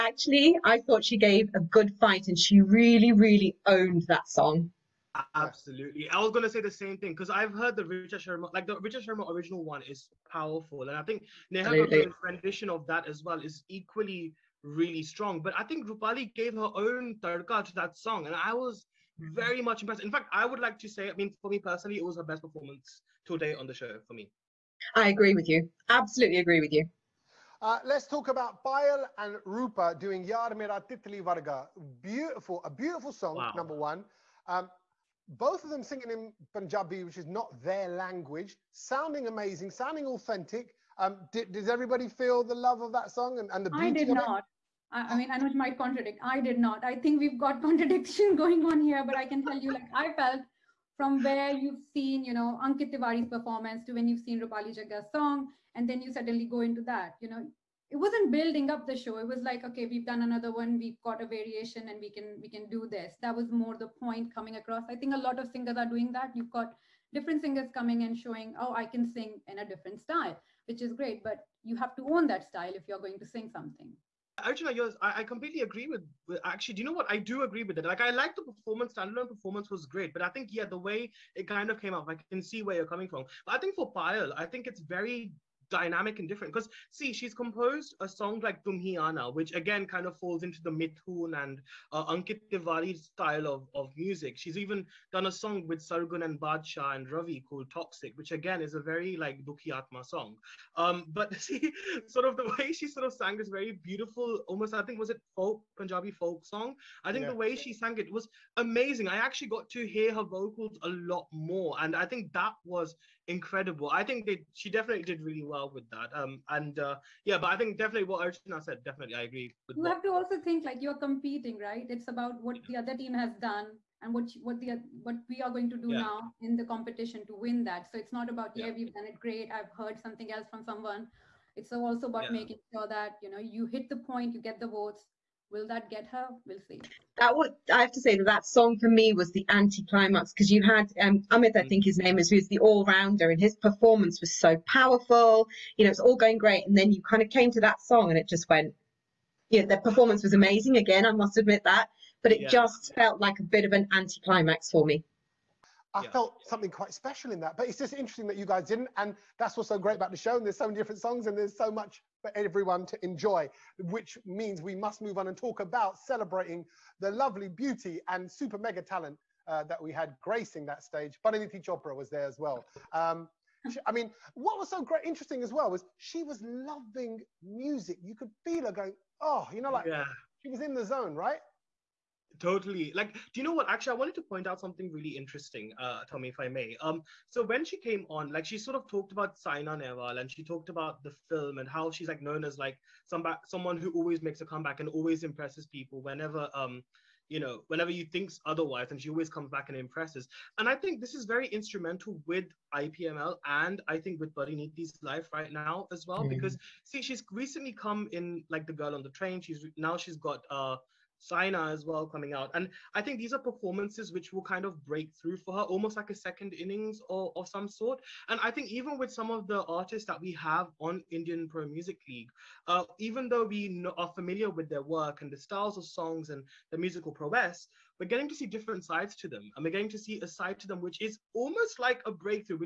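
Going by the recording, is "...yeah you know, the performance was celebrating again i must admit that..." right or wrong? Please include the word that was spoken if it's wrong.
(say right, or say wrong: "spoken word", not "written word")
wrong: "amazing", not "celebrating".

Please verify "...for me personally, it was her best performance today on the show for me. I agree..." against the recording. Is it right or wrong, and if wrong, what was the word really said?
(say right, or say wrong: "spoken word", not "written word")
right.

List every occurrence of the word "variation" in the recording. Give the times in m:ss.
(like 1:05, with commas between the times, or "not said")
1:01.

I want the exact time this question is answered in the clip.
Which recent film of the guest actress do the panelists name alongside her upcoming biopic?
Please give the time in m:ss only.
3:28.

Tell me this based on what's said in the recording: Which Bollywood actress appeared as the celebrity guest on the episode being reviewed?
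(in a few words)
Parineeti Chopra.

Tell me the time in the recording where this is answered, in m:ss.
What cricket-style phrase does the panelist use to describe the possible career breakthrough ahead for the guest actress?
3:36.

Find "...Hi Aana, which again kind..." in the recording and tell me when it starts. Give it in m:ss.
1:28.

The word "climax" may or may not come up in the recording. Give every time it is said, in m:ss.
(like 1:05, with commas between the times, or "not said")
2:19, 2:33.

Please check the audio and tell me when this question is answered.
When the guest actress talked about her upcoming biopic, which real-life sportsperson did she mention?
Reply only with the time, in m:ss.
3:09.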